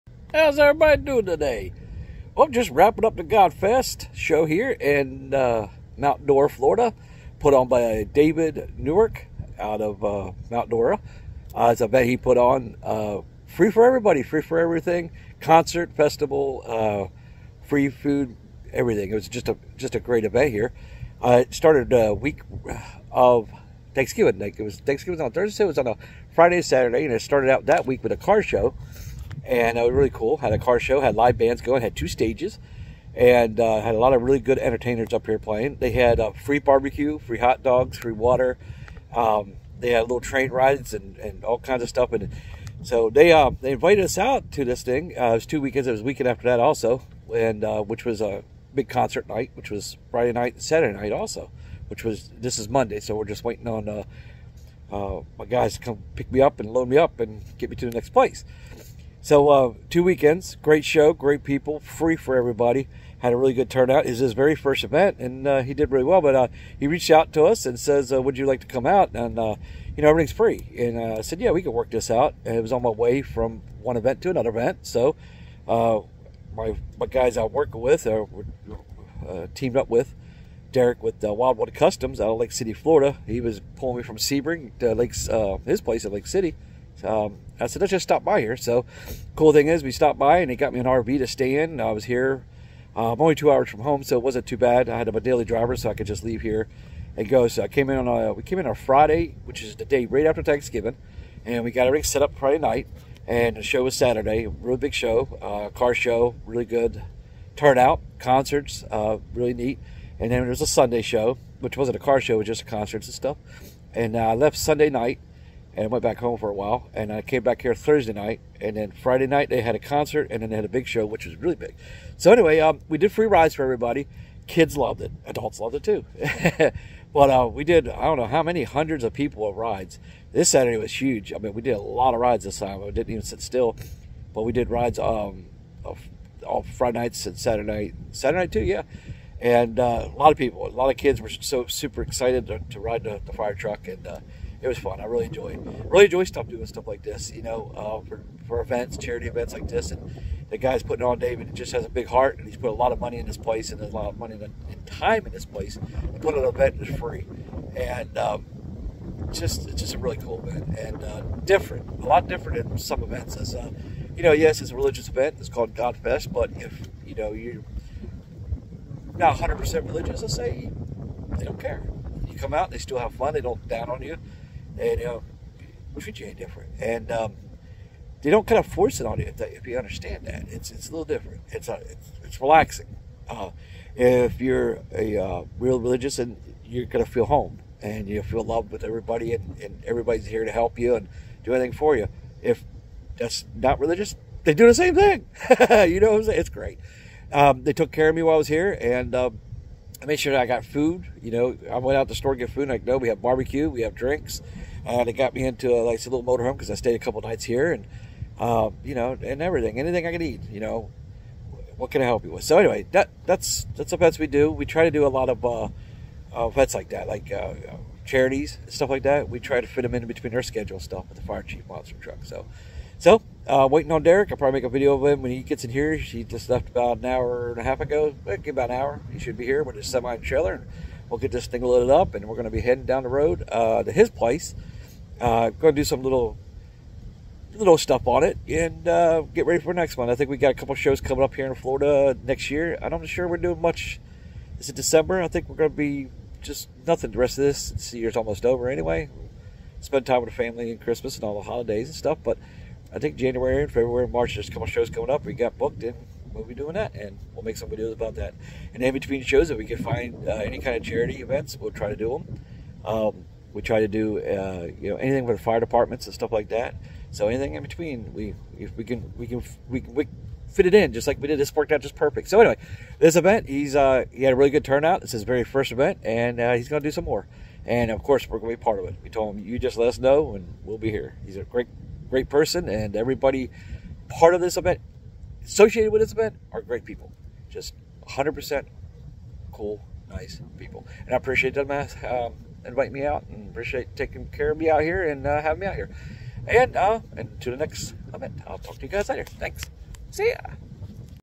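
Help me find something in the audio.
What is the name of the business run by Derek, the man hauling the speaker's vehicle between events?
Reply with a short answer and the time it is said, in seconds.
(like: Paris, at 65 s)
Wildwood Customs, at 81 s.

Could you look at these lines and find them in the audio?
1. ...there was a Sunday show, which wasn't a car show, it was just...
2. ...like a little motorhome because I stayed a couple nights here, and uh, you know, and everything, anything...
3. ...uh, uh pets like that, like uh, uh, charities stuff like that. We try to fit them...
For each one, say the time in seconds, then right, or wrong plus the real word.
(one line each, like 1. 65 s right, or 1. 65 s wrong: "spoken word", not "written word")
1. 110 s right
2. 205 s right
3. 215 s right.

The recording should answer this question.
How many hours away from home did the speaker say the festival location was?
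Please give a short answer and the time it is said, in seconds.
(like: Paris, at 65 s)
2, at 93 s.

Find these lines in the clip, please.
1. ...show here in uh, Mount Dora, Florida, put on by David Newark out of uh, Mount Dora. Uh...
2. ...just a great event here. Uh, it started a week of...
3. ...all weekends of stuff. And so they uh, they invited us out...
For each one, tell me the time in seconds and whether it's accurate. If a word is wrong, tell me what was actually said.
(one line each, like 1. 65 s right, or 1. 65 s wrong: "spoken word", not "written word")
1. 4 s right
2. 19 s right
3. 41 s wrong: "kinds", not "weekends".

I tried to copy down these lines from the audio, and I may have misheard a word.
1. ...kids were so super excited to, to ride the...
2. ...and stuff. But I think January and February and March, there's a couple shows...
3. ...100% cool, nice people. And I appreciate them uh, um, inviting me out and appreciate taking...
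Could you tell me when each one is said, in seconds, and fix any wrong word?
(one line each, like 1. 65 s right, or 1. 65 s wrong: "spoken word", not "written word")
1. 140 s right
2. 251 s right
3. 288 s right.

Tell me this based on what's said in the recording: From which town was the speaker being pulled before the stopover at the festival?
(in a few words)
Sebring.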